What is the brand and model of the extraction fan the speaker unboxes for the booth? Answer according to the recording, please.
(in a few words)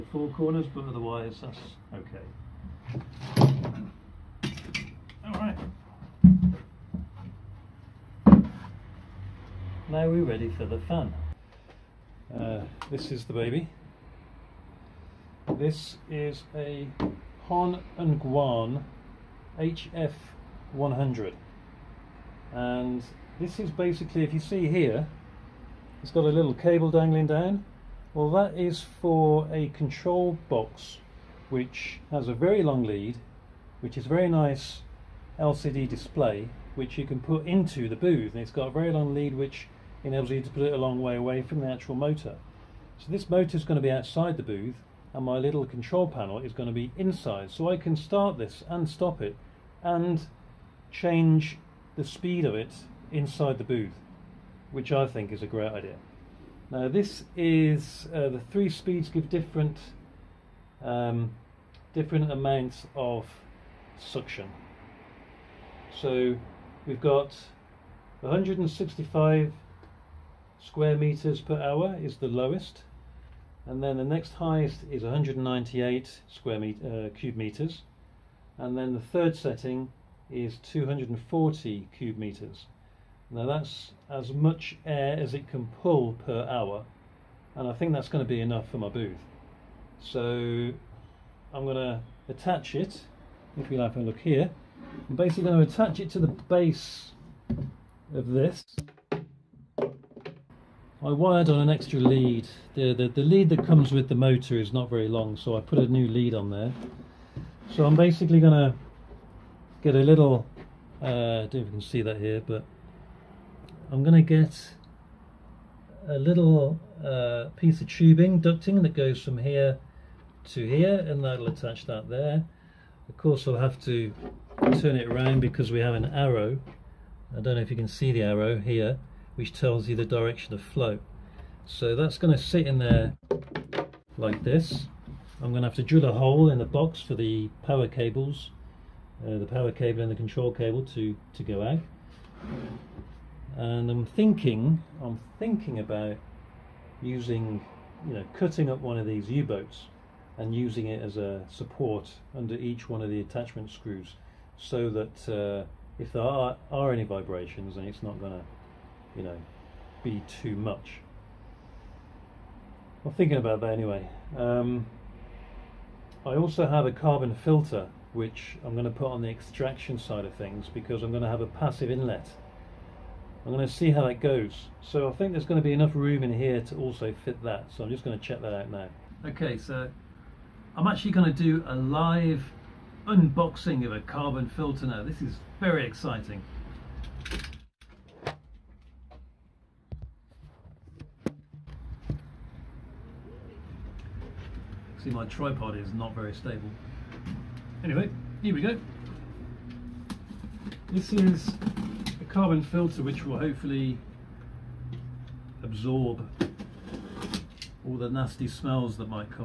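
Hon and Guan HF100.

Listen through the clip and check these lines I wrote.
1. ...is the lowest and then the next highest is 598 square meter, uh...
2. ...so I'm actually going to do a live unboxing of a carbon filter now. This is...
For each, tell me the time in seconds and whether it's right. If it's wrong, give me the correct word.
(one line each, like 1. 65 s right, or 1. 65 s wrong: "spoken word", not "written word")
1. 72 s wrong: "198", not "598"
2. 179 s right.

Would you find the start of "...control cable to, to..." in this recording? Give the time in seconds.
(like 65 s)
140 s.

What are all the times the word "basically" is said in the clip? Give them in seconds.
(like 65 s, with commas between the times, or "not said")
23 s, 95 s, 107 s.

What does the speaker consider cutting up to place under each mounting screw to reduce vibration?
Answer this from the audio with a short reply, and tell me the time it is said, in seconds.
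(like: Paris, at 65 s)
U-boats, at 149 s.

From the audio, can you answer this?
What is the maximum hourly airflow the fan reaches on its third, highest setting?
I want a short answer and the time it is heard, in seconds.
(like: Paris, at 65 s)
240 cubic meters, at 80 s.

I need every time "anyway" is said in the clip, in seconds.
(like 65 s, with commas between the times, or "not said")
163 s, 197 s.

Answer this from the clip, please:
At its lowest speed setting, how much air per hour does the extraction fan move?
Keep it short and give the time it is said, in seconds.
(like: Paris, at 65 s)
165, at 68 s.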